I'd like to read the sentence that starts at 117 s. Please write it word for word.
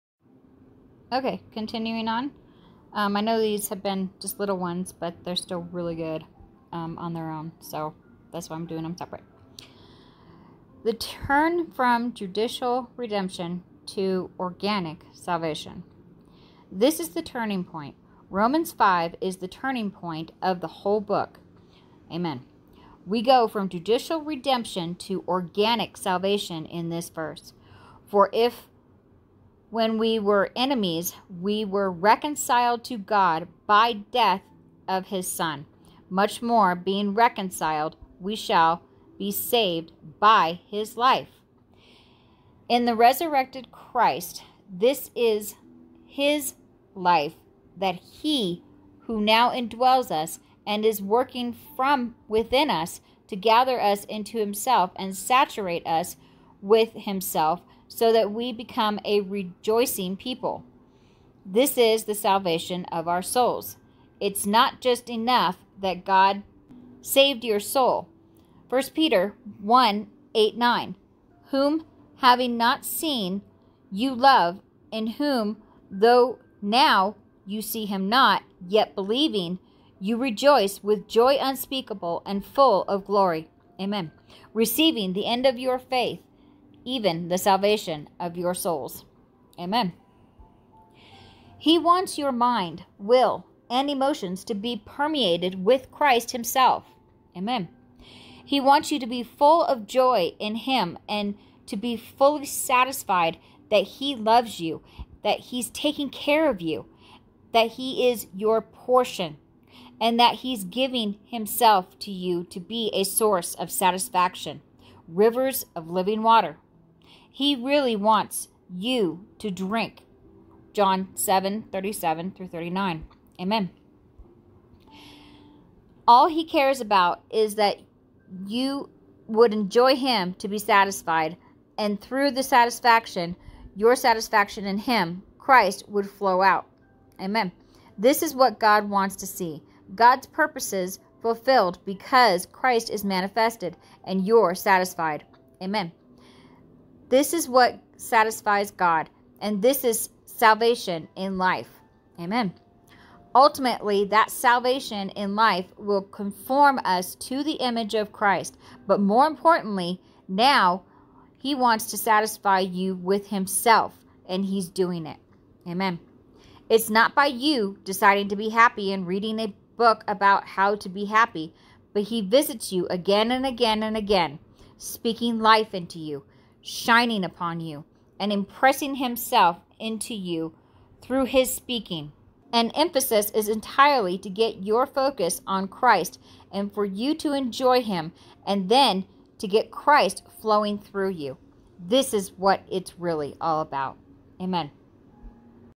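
He really wants you to drink.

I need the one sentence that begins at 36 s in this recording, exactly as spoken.
Much more, being reconciled, we shall be saved by his life.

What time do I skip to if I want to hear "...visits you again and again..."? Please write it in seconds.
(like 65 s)
172 s.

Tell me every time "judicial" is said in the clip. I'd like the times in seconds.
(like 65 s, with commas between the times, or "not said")
12 s, 23 s.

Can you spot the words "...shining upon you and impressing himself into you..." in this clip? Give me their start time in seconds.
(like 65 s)
176 s.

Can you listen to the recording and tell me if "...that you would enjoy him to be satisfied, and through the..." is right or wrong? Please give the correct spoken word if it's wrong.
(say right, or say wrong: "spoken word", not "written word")
right.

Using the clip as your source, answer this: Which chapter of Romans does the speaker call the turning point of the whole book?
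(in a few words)
Romans 5.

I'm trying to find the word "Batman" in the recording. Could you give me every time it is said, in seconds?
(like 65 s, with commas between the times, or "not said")
not said.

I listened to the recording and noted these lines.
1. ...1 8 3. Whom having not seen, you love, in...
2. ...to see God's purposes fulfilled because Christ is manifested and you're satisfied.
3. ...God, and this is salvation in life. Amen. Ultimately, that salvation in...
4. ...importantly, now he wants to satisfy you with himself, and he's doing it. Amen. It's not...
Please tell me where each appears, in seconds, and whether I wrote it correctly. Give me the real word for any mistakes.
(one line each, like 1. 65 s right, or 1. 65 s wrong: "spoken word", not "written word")
1. 69 s wrong: "9", not "3"
2. 139 s right
3. 148 s right
4. 159 s right.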